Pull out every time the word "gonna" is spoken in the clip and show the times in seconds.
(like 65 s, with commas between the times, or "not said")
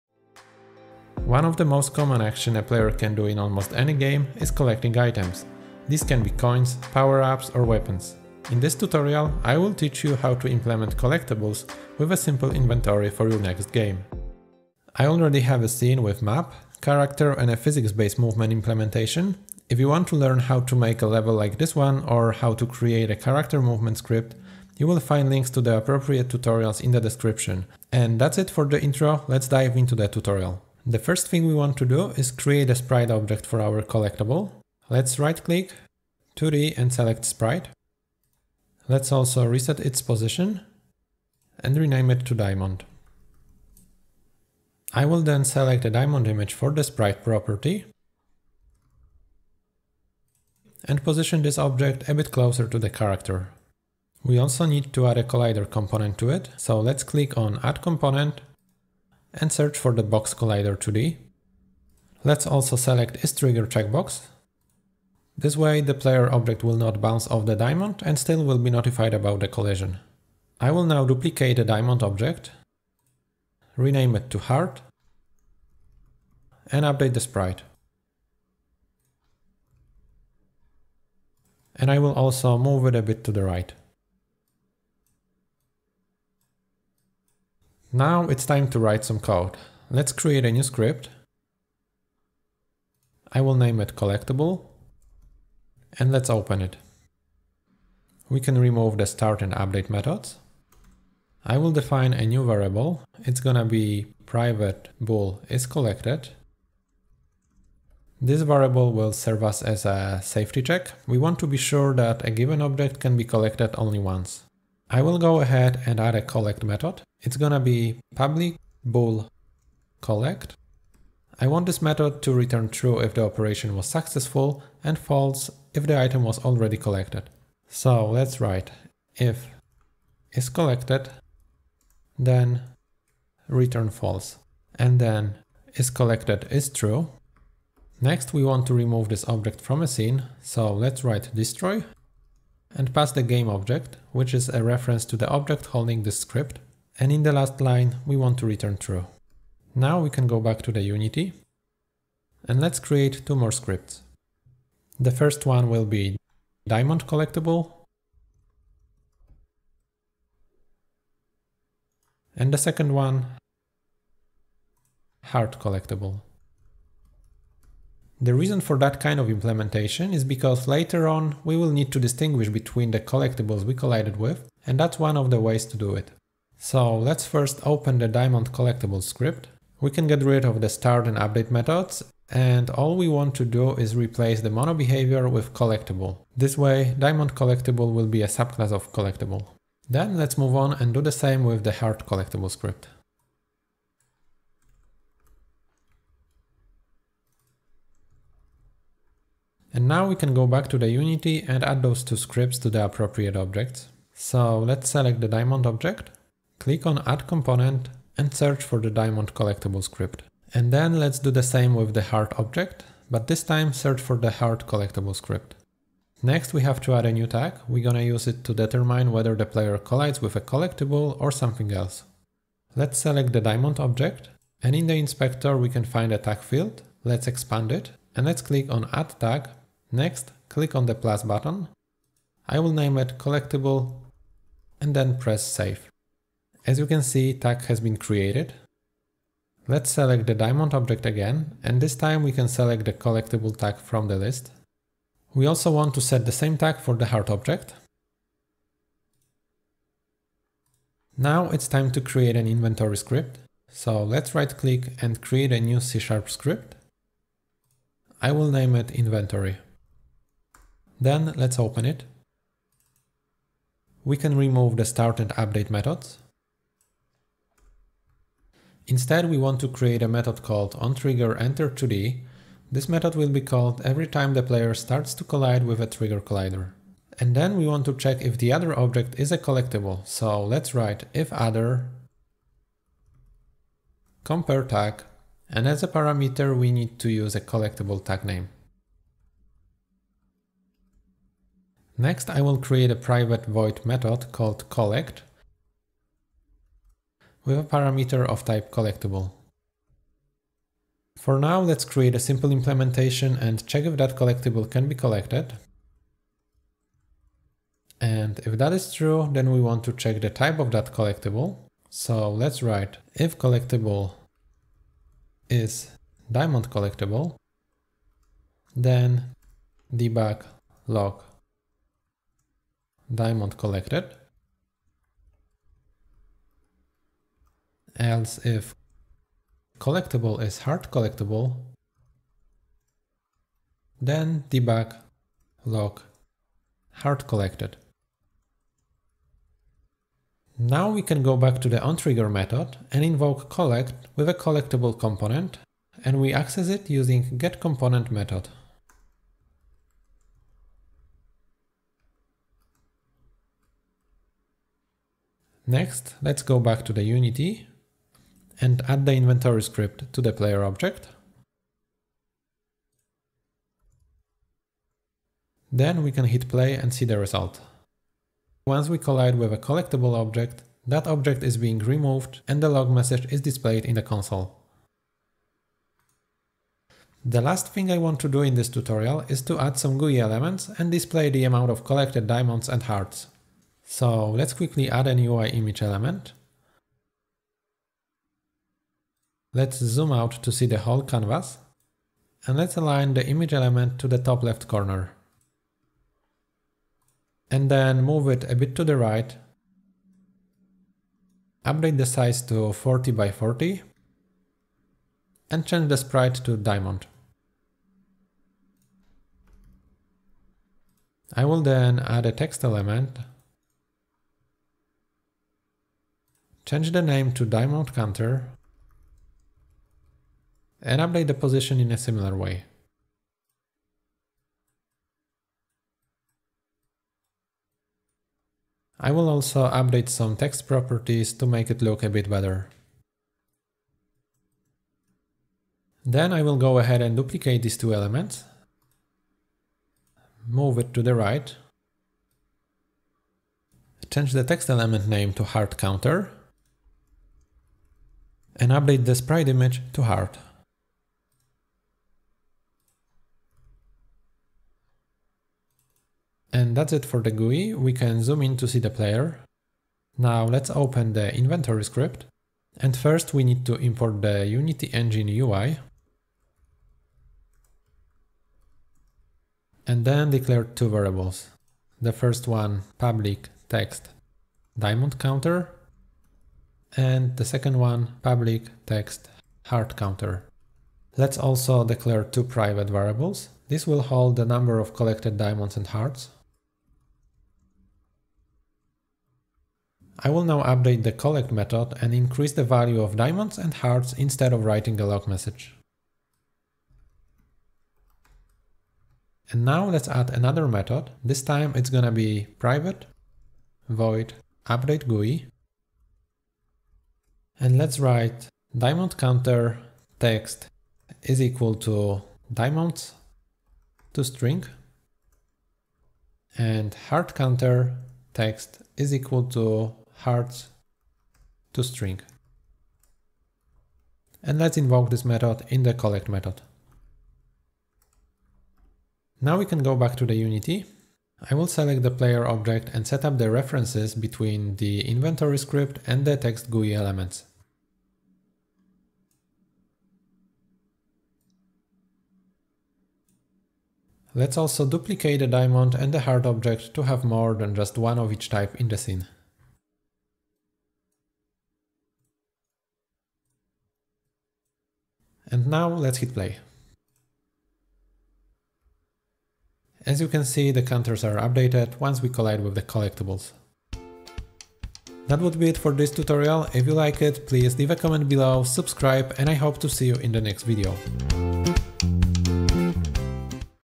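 103 s, 117 s, 217 s, 501 s.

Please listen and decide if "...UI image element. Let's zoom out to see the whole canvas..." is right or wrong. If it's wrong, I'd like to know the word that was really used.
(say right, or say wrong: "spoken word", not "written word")
right.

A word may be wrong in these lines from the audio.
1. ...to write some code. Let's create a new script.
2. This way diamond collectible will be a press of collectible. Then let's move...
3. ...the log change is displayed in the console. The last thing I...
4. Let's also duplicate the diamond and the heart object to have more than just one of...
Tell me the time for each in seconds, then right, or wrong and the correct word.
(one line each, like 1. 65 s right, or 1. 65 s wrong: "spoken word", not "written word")
1. 88 s right
2. 186 s wrong: "subclass", not "press"
3. 372 s wrong: "message", not "change"
4. 544 s right.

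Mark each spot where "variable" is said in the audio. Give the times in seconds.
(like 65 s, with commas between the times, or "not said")
102 s, 108 s, 470 s, 482 s.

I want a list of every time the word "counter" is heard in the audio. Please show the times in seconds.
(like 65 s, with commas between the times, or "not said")
417 s, 445 s, 475 s, 479 s, 509 s, 517 s, 560 s.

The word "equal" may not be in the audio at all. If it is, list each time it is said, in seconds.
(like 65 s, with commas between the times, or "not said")
511 s, 519 s.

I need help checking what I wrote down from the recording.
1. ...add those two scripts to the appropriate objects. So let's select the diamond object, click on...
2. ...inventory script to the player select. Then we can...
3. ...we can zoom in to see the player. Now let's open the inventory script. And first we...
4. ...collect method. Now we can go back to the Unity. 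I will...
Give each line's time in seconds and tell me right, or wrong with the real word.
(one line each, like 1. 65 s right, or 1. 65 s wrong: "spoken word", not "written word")
1. 201 s right
2. 359 s wrong: "object", not "select"
3. 457 s right
4. 525 s right.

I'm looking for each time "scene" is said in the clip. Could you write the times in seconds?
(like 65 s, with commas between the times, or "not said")
15 s, 139 s, 548 s.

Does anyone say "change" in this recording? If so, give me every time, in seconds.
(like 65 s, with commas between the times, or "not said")
405 s, 416 s, 444 s.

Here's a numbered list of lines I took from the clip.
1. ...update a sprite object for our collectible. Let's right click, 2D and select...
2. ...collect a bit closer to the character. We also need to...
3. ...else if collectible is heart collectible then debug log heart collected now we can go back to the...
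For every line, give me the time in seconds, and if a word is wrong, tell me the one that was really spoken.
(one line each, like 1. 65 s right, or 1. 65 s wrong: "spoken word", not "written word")
1. 32 s wrong: "create", not "update"
2. 51 s wrong: "object", not "collect"
3. 327 s right.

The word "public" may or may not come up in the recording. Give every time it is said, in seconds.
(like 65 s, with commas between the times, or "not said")
118 s, 472 s, 478 s.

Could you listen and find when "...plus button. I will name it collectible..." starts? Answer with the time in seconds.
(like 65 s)
230 s.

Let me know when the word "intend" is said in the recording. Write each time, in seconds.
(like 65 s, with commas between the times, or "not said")
not said.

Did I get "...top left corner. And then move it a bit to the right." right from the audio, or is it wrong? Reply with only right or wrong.
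right.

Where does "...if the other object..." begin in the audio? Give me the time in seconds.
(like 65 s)
278 s.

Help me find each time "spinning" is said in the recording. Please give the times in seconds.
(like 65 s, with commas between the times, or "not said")
not said.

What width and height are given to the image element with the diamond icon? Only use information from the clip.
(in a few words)
40 by 40.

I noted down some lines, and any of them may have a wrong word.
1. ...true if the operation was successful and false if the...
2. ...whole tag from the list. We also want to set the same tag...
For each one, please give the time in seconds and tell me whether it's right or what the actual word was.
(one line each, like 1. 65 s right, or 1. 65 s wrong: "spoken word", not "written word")
1. 122 s right
2. 242 s wrong: "collectible", not "whole".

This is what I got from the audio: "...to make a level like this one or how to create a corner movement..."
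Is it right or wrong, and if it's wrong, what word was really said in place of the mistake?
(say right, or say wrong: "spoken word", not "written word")
wrong: "character", not "corner".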